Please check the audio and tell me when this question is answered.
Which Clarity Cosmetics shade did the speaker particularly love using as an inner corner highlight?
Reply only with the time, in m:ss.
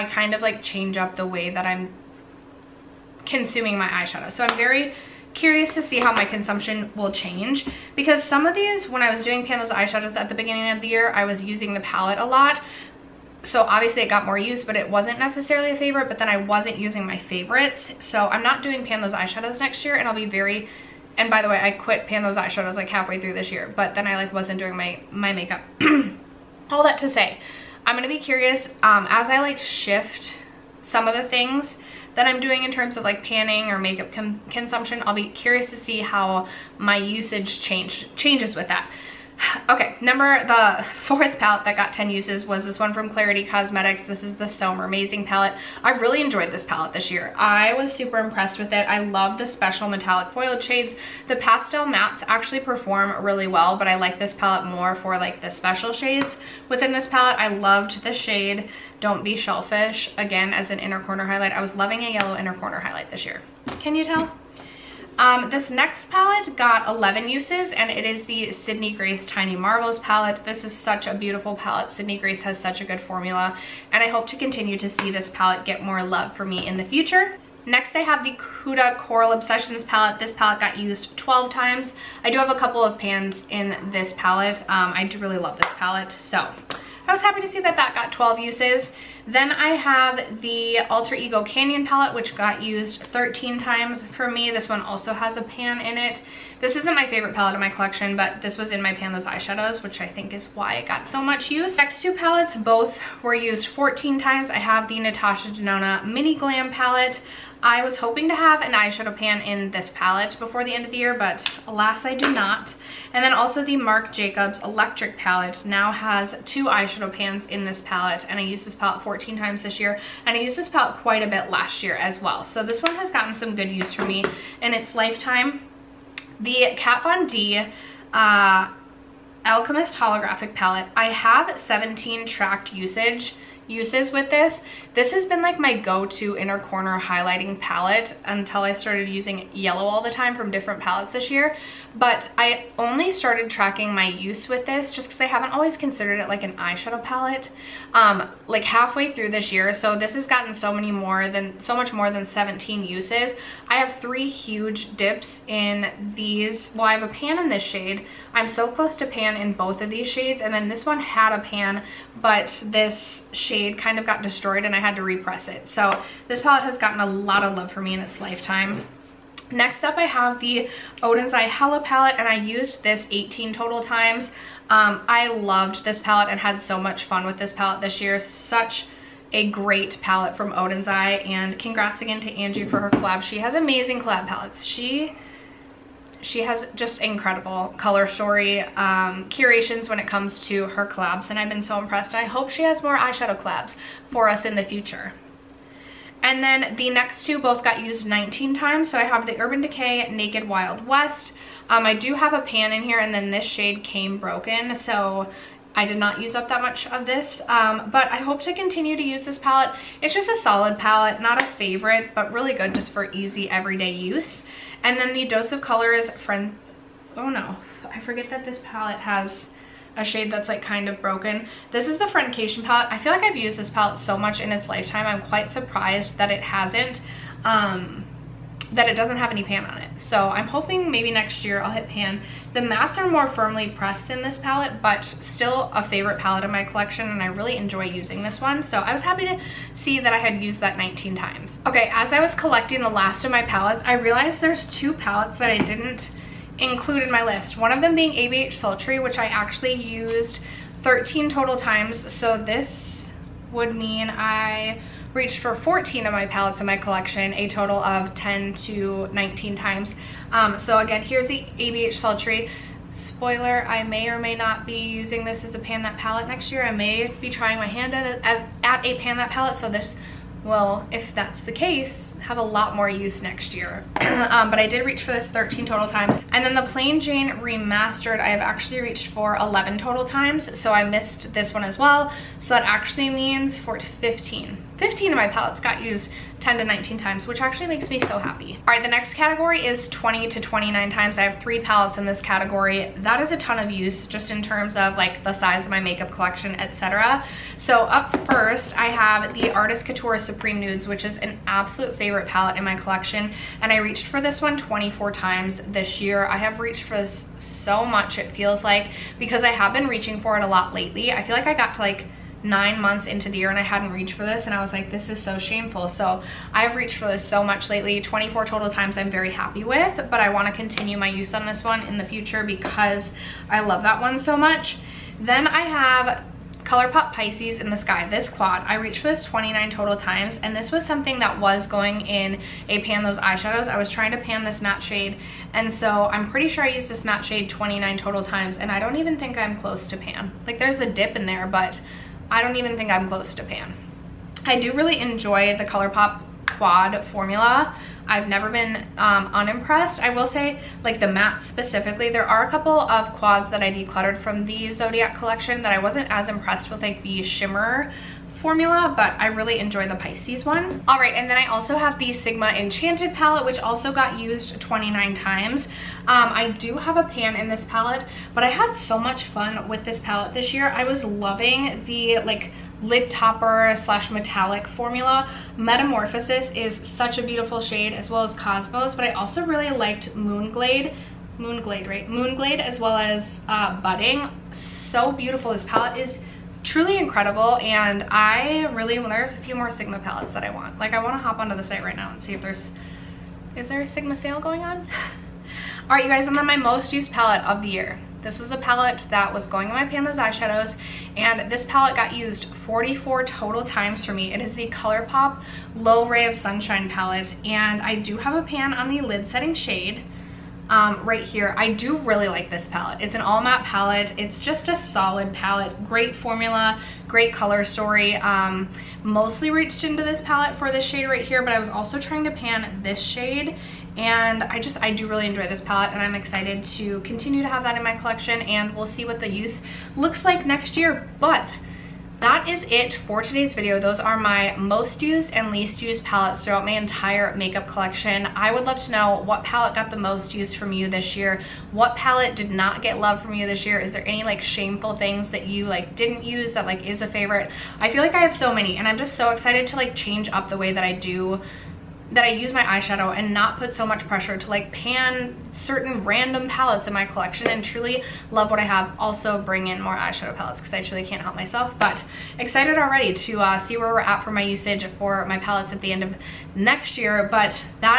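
0:58.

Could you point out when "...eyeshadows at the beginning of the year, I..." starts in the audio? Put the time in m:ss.
0:09.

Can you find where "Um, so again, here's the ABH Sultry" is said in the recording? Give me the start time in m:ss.
4:20.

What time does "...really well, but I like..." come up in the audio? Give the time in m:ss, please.
0:53.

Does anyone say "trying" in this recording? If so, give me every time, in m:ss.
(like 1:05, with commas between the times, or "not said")
4:27, 5:33, 7:01.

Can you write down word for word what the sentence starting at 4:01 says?
Okay, as I was collecting the last of my palettes, I realized there's two palettes that I didn't include in my list.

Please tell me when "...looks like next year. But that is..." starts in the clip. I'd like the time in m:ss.
7:09.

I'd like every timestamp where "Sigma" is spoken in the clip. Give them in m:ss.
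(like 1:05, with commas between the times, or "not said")
6:02, 6:29, 6:33.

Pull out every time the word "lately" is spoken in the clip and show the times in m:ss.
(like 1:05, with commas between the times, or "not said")
5:10, 5:17.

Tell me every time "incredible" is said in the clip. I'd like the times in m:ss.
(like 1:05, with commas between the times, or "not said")
3:07, 6:26.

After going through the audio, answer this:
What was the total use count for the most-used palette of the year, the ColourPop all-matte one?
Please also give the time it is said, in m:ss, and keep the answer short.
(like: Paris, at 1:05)
44, at 6:42.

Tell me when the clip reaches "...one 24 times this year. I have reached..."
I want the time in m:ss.
5:04.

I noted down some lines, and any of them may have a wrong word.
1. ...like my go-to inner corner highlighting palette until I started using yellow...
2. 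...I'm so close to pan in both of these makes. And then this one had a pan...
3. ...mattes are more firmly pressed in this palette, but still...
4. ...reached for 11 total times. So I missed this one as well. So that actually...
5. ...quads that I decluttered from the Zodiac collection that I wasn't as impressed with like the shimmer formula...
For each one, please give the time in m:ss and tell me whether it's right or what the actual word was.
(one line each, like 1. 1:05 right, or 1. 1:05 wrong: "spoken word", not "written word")
1. 2:15 right
2. 2:38 wrong: "shades", not "makes"
3. 3:52 right
4. 4:38 right
5. 5:53 right.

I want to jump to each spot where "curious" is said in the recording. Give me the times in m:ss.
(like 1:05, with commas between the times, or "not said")
0:05, 0:28, 0:35.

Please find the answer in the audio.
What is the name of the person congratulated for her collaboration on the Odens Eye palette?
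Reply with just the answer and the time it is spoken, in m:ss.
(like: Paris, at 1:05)
Angie, at 3:02.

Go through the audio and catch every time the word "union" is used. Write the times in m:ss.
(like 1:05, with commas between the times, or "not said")
not said.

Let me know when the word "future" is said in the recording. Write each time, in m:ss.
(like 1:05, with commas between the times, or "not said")
1:16, 3:14, 5:22.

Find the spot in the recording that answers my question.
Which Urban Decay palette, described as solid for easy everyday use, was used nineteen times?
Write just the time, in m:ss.
3:20.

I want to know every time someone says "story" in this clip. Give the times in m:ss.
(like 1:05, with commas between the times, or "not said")
3:08, 6:57.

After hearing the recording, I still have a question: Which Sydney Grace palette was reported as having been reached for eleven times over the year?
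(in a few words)
Tiny Marvels.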